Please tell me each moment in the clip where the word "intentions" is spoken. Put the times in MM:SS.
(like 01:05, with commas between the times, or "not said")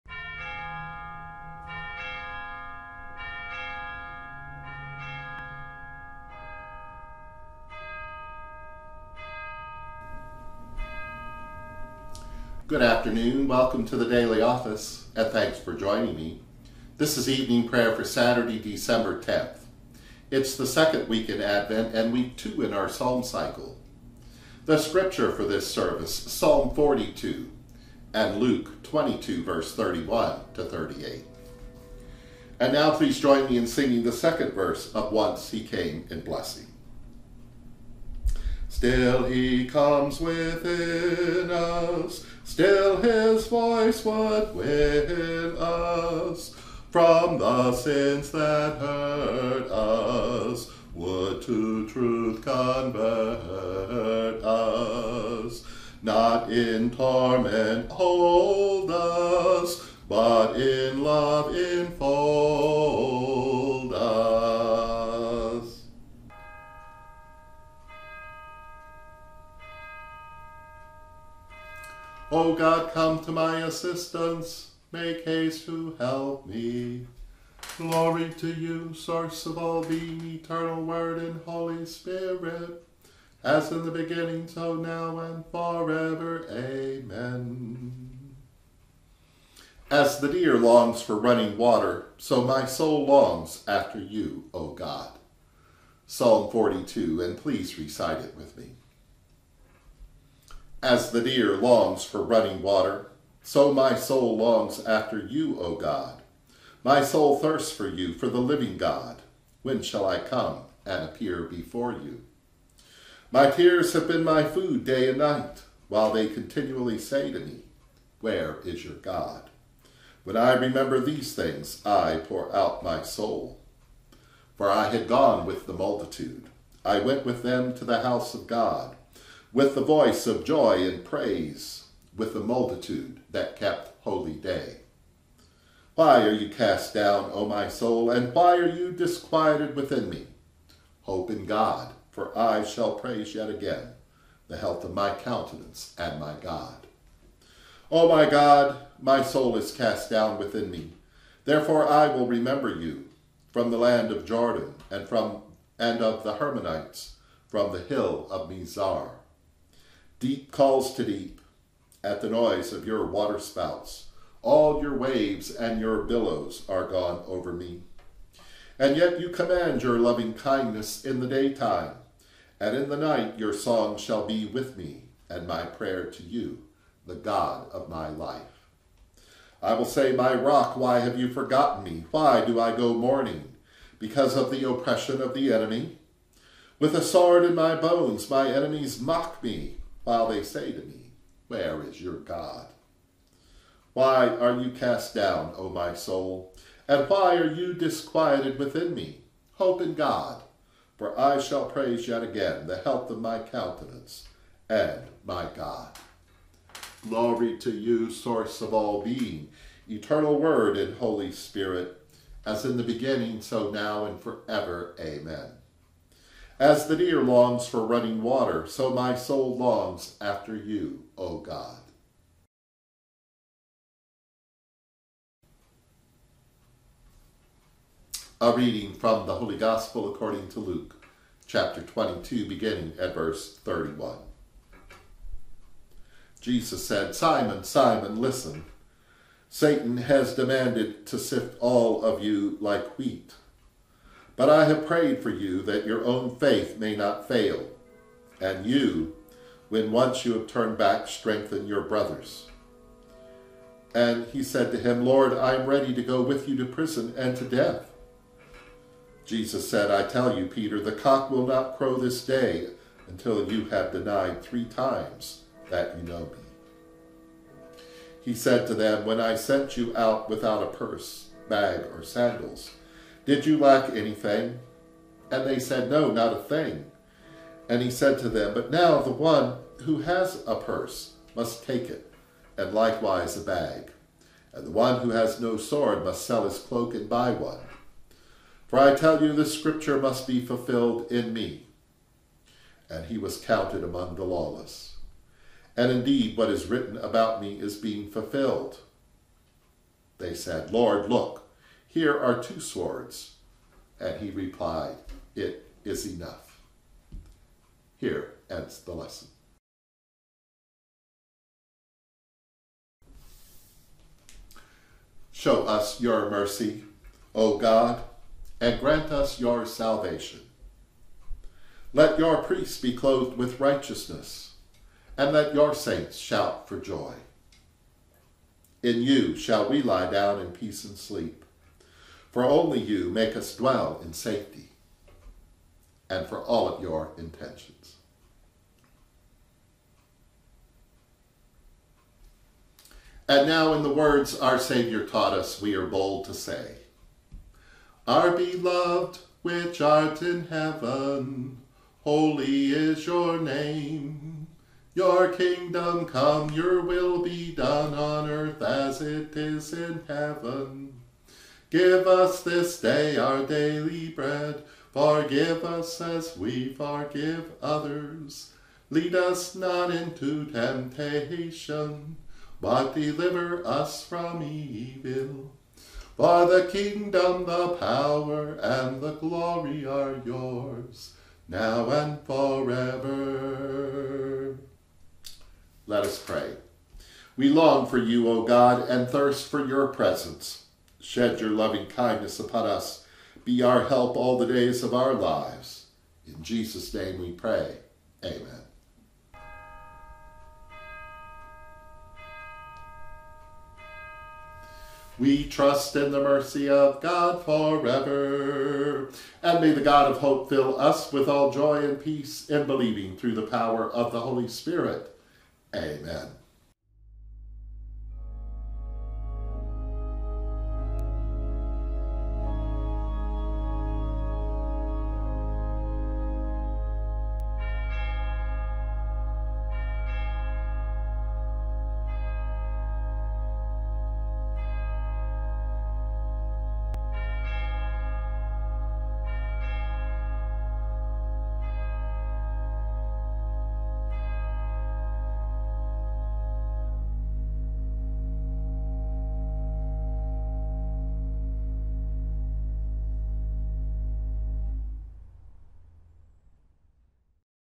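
05:37.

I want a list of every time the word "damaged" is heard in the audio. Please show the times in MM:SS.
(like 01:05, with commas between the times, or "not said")
not said.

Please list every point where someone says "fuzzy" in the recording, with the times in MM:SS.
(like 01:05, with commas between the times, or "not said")
not said.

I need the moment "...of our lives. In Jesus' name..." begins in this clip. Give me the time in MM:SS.
06:34.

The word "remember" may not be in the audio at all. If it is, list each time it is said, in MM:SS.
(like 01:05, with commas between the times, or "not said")
02:00, 02:32.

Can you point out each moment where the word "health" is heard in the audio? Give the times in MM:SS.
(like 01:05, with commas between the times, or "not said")
02:24, 03:22.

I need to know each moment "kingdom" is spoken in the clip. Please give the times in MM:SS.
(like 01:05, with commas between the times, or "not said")
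05:55, 06:16.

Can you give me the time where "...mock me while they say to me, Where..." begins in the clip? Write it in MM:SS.
03:09.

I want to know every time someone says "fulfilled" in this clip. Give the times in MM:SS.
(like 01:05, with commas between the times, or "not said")
04:50, 04:58.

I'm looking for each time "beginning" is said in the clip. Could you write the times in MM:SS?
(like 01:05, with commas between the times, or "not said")
01:23, 03:32, 03:52.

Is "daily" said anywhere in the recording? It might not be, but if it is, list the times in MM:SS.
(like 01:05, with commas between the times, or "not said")
00:14, 06:03.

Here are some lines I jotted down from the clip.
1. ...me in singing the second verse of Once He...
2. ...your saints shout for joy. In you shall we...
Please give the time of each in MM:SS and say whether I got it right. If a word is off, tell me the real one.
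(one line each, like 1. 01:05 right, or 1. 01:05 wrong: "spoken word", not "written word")
1. 00:33 right
2. 05:25 right.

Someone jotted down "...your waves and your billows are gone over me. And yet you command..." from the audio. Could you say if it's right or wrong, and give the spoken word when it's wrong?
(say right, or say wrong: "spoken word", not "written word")
right.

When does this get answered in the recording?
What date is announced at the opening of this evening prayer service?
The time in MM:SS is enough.
00:18.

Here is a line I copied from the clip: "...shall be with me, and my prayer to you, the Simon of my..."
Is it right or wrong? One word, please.
wrong.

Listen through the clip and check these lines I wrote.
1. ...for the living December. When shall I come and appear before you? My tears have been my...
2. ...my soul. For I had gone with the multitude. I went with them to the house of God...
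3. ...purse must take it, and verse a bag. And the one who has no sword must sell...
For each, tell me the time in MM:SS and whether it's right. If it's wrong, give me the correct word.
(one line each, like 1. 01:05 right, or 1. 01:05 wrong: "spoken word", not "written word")
1. 01:48 wrong: "God", not "December"
2. 02:02 right
3. 04:40 wrong: "likewise", not "verse".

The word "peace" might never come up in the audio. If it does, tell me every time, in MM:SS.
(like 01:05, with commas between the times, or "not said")
05:30, 06:52.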